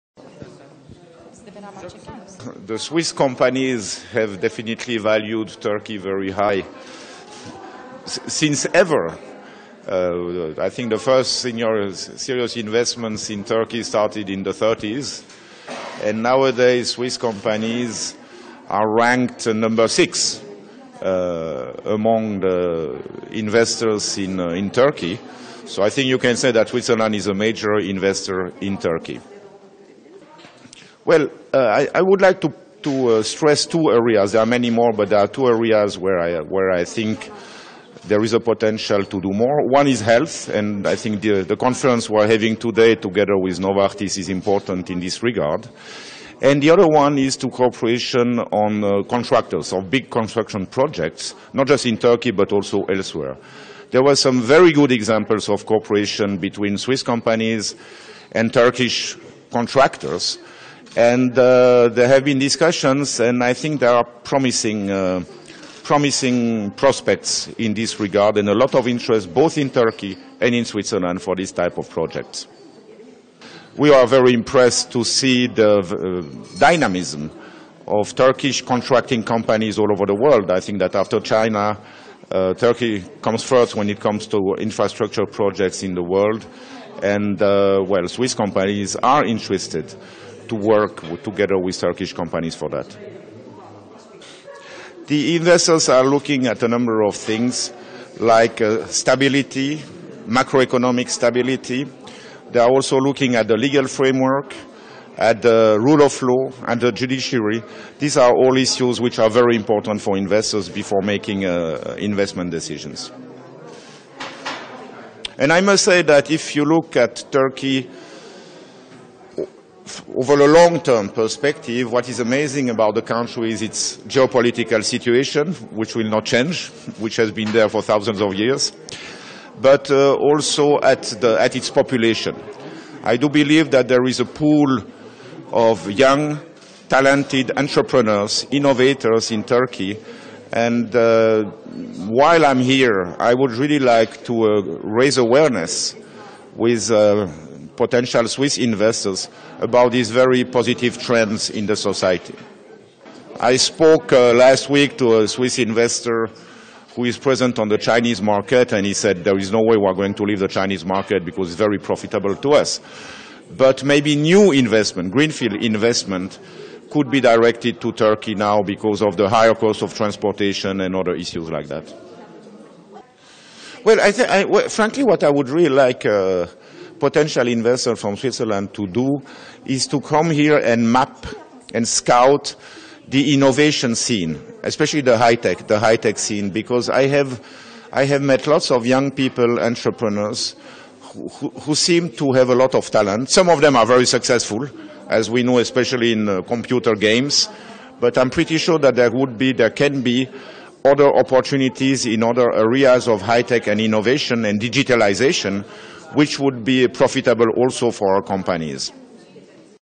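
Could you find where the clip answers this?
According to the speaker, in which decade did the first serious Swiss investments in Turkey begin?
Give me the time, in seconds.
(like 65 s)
14 s.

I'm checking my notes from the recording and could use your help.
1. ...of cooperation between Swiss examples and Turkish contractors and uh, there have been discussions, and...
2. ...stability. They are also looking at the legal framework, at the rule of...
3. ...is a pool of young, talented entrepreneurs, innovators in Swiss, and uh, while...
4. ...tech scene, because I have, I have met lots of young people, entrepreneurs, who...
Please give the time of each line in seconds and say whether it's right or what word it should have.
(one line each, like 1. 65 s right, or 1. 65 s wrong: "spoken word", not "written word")
1. 55 s wrong: "companies", not "examples"
2. 101 s right
3. 134 s wrong: "Turkey", not "Swiss"
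4. 185 s right.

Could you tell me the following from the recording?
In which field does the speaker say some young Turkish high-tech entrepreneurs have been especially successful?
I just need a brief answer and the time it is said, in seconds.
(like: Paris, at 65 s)
Computer games, at 196 s.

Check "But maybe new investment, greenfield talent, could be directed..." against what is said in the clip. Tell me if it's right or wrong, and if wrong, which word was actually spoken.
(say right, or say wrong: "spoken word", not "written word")
wrong: "investment", not "talent".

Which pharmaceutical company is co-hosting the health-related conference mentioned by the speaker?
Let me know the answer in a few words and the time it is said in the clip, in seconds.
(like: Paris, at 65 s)
Novartis, at 43 s.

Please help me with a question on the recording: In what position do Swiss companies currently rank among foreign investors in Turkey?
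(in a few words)
6.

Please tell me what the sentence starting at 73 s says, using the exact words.
We are very impressed to see the uh, dynamism of Turkish contracting companies all over the world.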